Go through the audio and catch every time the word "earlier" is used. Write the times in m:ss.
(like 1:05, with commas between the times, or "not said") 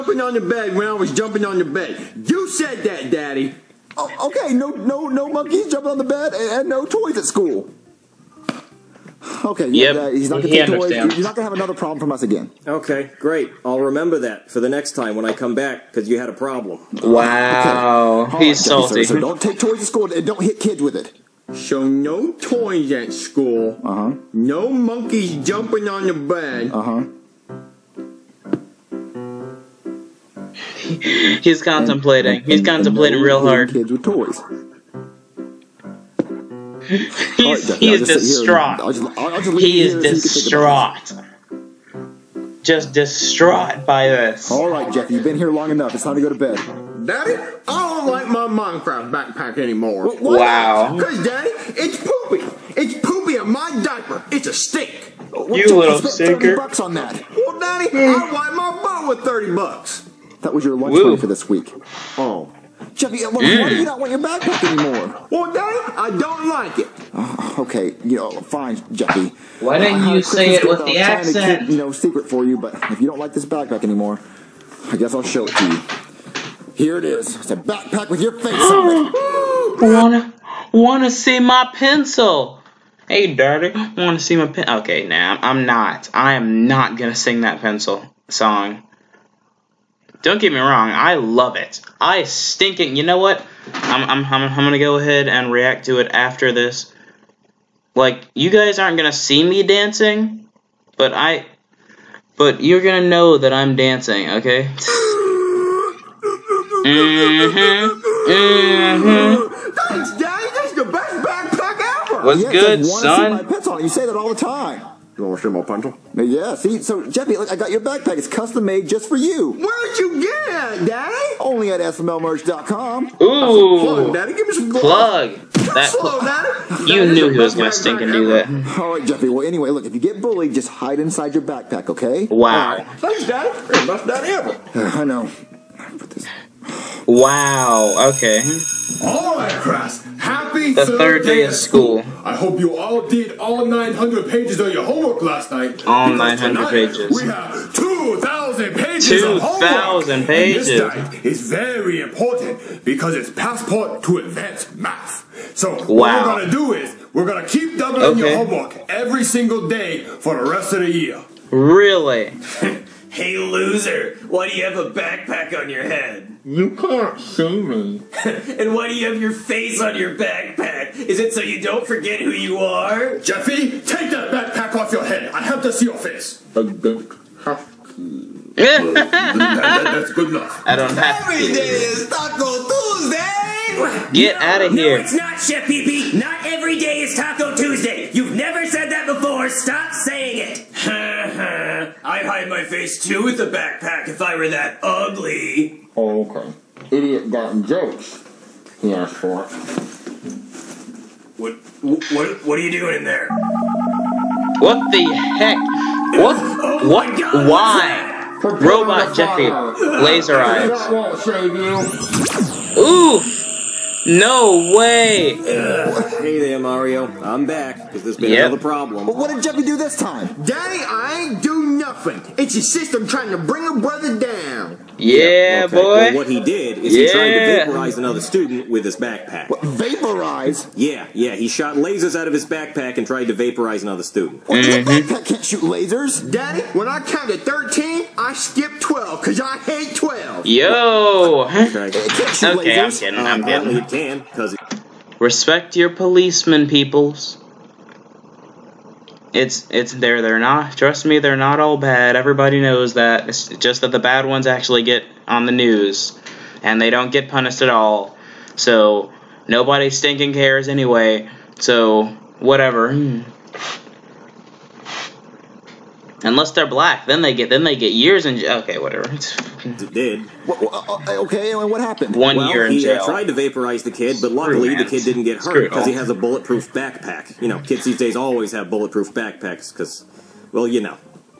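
not said.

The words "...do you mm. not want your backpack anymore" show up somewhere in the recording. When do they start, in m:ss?
1:03.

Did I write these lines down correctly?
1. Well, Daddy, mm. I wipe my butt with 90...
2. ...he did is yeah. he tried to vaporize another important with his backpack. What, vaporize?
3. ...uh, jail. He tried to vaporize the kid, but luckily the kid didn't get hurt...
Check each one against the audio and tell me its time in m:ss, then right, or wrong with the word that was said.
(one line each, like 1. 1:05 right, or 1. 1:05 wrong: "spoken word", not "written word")
1. 0:57 wrong: "30", not "90"
2. 3:46 wrong: "student", not "important"
3. 4:32 right.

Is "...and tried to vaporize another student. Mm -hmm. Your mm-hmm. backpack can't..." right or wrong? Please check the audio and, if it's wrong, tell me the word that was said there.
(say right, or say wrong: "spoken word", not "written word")
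right.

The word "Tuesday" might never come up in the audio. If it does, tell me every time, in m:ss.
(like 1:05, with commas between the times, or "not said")
3:02, 3:07.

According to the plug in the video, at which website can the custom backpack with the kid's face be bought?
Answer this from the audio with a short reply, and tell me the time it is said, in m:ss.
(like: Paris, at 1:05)
SMLmerch.com, at 2:01.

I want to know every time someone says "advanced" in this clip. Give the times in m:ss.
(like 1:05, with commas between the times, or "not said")
2:34.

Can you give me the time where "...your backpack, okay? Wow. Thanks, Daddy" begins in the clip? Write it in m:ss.
2:11.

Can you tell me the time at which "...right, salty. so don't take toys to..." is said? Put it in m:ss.
0:18.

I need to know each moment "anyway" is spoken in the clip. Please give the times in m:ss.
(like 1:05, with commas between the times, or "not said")
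2:09, 4:20.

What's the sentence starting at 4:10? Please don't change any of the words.
Trust me, they're not all bad.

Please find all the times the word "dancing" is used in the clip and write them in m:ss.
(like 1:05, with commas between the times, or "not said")
1:39, 1:43.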